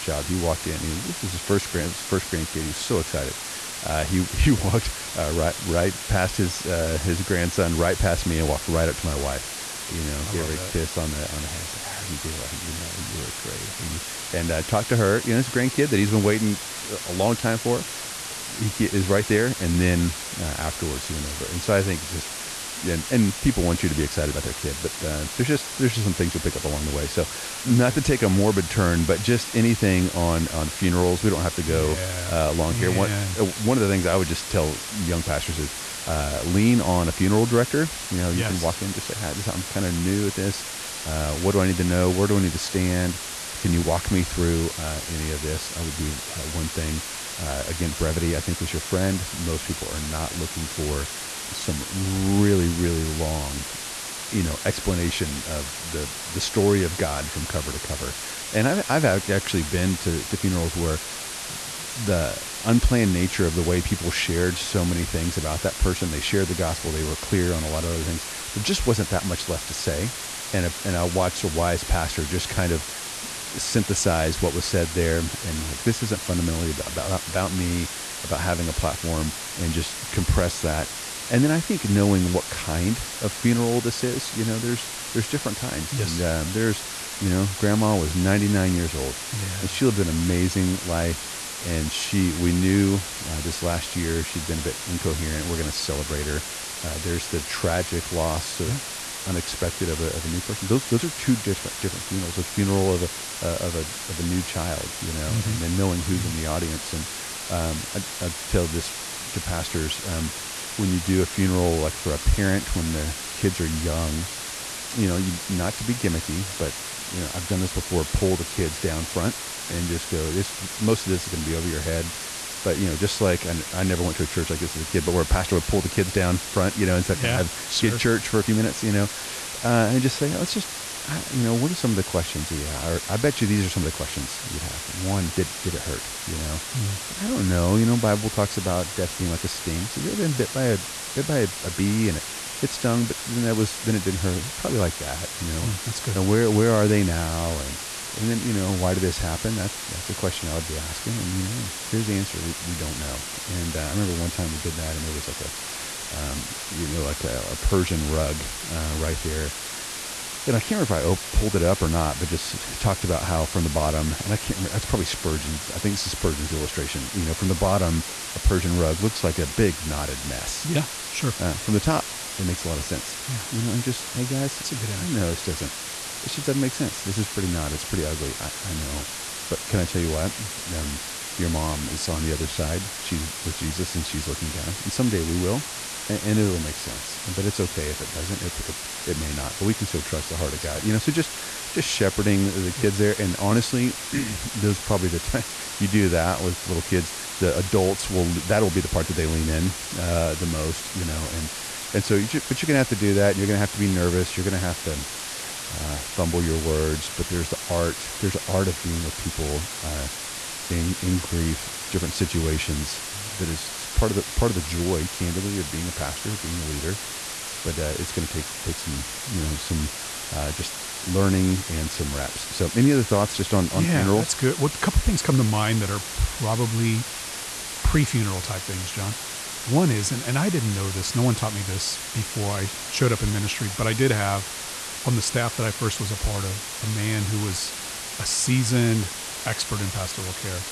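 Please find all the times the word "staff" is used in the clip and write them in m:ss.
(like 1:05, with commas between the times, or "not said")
3:55.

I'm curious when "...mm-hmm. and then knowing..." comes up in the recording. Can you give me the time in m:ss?
1:45.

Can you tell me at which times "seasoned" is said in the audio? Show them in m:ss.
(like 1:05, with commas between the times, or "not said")
3:58.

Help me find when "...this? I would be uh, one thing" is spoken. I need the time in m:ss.
0:45.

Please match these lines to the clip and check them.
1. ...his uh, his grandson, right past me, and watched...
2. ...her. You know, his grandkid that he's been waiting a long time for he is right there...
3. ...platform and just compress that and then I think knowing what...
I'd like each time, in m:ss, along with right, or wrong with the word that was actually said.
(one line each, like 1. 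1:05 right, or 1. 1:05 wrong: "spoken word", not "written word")
1. 0:06 wrong: "walked", not "watched"
2. 0:14 right
3. 1:18 right.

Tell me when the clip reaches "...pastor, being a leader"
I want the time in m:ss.
3:35.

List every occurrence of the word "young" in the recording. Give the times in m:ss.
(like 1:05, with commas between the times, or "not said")
0:34, 1:53.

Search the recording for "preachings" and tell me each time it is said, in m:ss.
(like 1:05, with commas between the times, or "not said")
not said.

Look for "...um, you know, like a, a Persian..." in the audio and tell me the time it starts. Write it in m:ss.
2:36.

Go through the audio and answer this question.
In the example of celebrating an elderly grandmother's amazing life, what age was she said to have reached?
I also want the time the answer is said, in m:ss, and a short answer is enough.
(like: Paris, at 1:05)
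99, at 1:28.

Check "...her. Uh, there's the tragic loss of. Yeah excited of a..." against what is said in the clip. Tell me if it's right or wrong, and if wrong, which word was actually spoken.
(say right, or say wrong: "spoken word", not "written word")
wrong: "unexpected", not "excited".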